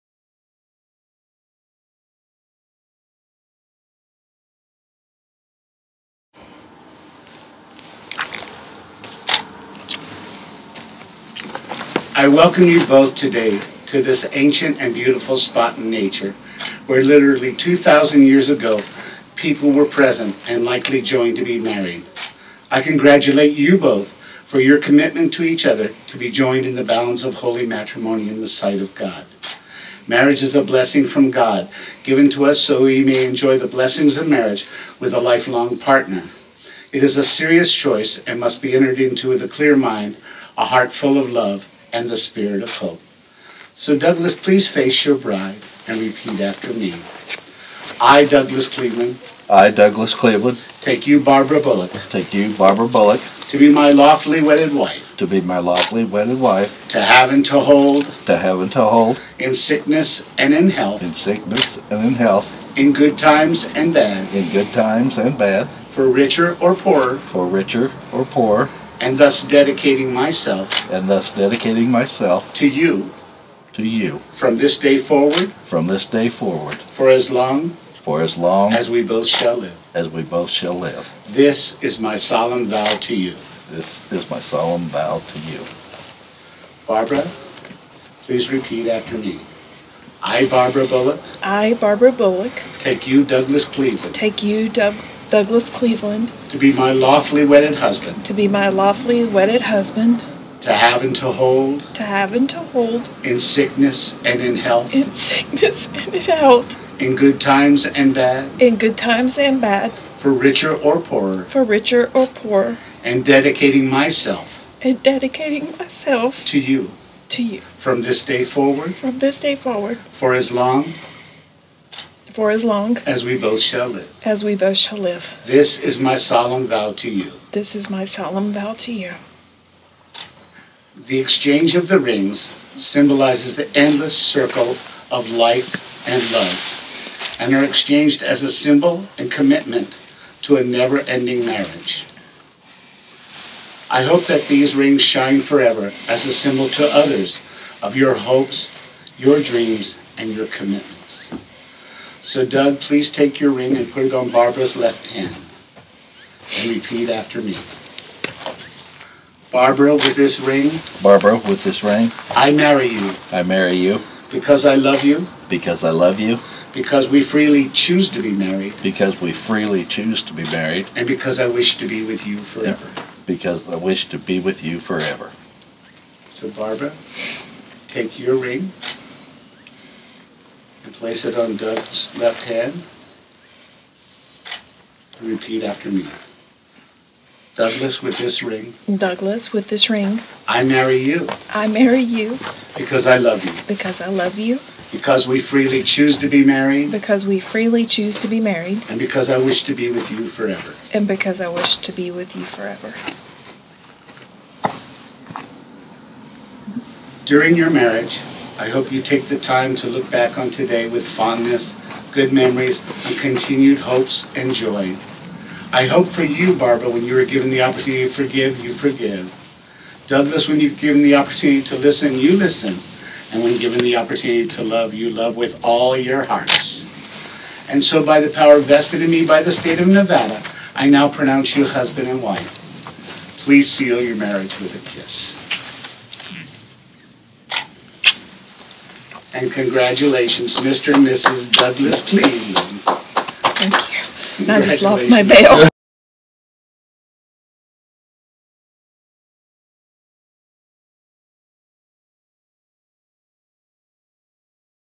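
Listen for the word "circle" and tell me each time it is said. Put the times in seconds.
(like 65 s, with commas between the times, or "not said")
134 s.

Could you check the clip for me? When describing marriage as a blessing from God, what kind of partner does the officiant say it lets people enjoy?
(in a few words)
lifelong partner.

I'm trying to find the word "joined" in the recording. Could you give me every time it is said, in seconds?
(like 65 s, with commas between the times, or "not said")
21 s, 26 s.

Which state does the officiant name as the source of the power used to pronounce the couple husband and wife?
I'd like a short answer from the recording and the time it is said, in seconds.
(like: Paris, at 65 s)
Nevada, at 229 s.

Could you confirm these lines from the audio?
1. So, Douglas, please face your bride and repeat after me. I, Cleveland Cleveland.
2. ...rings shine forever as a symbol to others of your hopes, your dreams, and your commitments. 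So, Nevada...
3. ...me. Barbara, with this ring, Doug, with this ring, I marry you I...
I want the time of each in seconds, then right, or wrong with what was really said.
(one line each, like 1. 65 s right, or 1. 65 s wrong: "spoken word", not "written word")
1. 43 s wrong: "Douglas", not "Cleveland"
2. 144 s wrong: "Doug", not "Nevada"
3. 157 s wrong: "Barbara", not "Doug".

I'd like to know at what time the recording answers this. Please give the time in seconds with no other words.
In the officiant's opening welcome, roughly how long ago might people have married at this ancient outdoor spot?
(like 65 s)
17 s.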